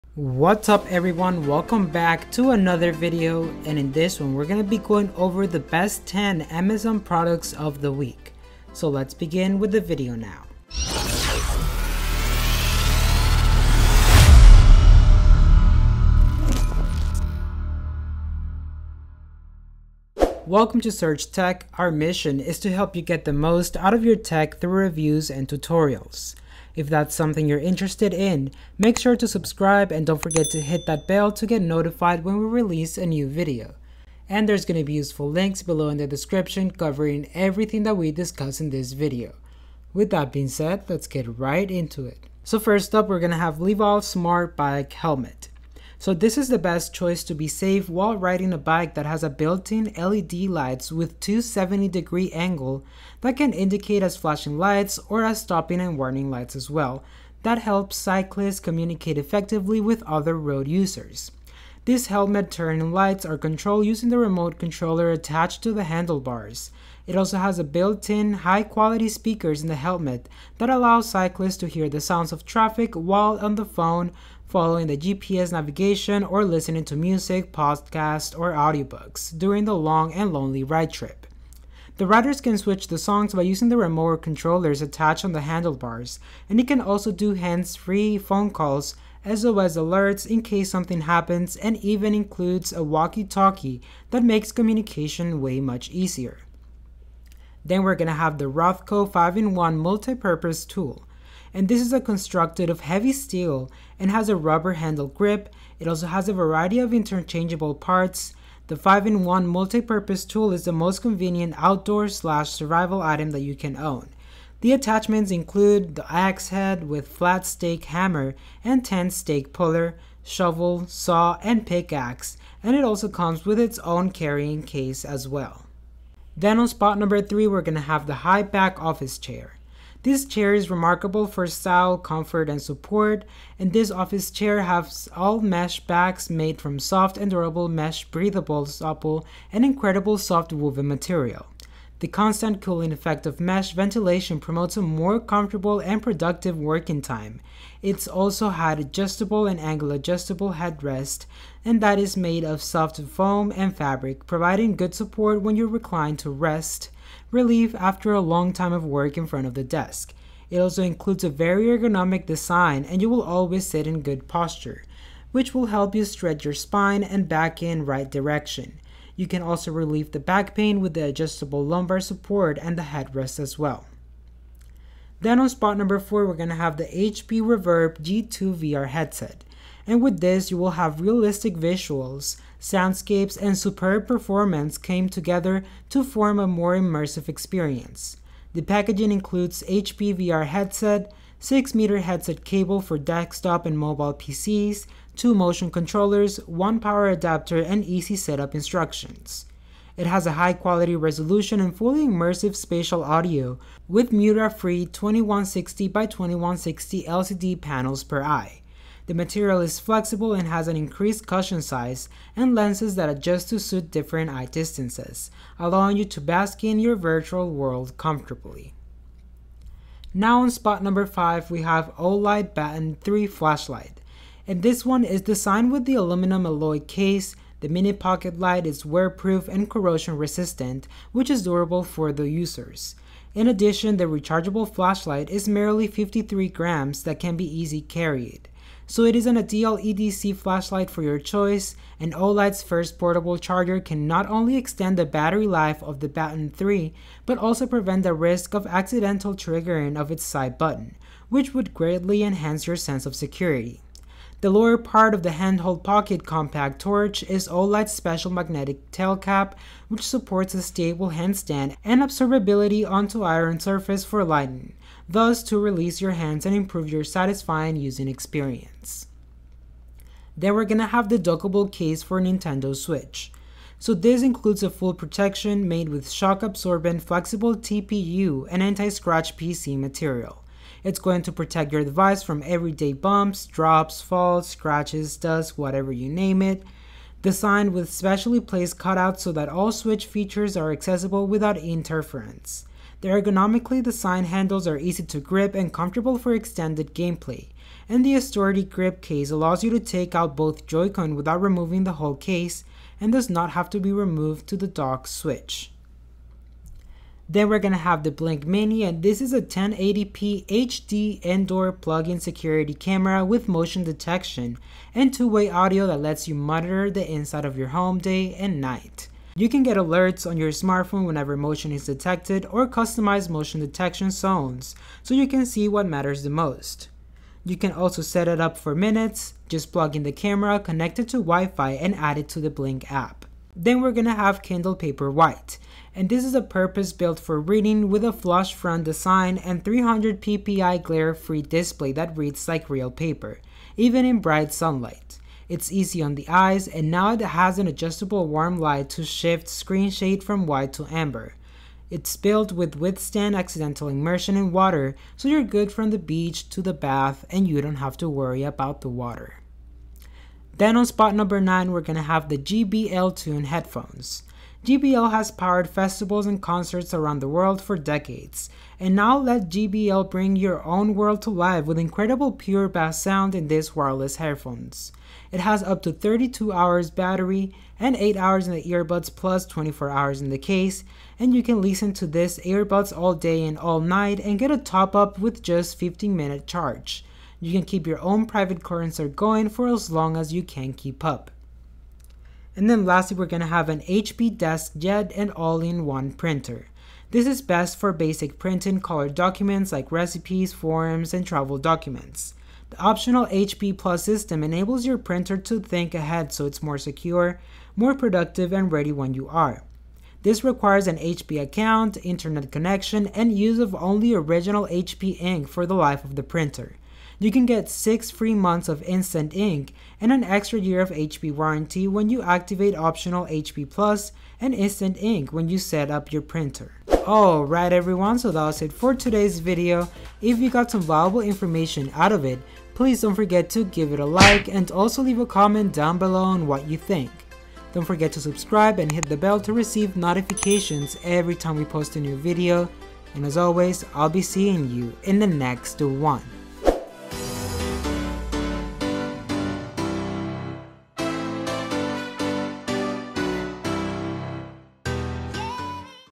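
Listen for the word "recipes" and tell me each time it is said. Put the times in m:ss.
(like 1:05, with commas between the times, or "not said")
6:39.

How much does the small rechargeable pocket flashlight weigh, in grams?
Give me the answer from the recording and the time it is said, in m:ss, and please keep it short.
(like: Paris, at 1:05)
53, at 3:55.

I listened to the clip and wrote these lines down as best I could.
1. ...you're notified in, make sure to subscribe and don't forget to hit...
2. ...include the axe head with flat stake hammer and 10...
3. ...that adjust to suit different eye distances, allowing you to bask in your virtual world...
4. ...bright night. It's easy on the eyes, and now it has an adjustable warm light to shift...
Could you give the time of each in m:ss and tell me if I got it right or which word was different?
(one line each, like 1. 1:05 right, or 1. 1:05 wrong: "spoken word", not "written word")
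1. 0:27 wrong: "interested", not "notified"
2. 1:55 right
3. 3:32 right
4. 5:44 wrong: "sunlight", not "night".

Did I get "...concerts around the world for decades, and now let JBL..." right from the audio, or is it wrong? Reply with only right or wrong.
right.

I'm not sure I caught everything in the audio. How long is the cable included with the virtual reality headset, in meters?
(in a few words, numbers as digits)
6.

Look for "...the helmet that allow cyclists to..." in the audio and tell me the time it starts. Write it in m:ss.
1:09.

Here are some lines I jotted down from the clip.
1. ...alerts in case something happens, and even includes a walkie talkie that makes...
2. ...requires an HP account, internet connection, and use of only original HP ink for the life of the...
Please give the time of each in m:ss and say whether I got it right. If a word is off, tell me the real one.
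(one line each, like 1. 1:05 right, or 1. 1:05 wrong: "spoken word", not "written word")
1. 1:29 right
2. 6:50 right.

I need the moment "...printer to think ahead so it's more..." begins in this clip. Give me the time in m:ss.
6:44.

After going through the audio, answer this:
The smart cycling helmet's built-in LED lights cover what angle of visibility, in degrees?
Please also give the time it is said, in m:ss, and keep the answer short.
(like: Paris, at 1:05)
270, at 0:51.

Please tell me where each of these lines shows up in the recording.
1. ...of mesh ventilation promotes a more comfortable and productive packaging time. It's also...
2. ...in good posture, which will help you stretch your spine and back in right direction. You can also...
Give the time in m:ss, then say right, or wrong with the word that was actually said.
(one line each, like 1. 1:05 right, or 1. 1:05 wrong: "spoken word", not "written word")
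1. 2:23 wrong: "working", not "packaging"
2. 2:43 right.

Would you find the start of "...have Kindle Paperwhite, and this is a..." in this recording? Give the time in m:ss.
5:34.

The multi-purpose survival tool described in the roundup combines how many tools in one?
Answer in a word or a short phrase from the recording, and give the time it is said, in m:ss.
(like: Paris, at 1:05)
5, at 1:39.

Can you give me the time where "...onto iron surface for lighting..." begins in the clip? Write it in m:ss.
4:22.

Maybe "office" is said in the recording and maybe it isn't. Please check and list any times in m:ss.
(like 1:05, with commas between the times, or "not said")
2:08, 2:13.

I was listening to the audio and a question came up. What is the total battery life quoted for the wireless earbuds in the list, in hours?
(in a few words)
32.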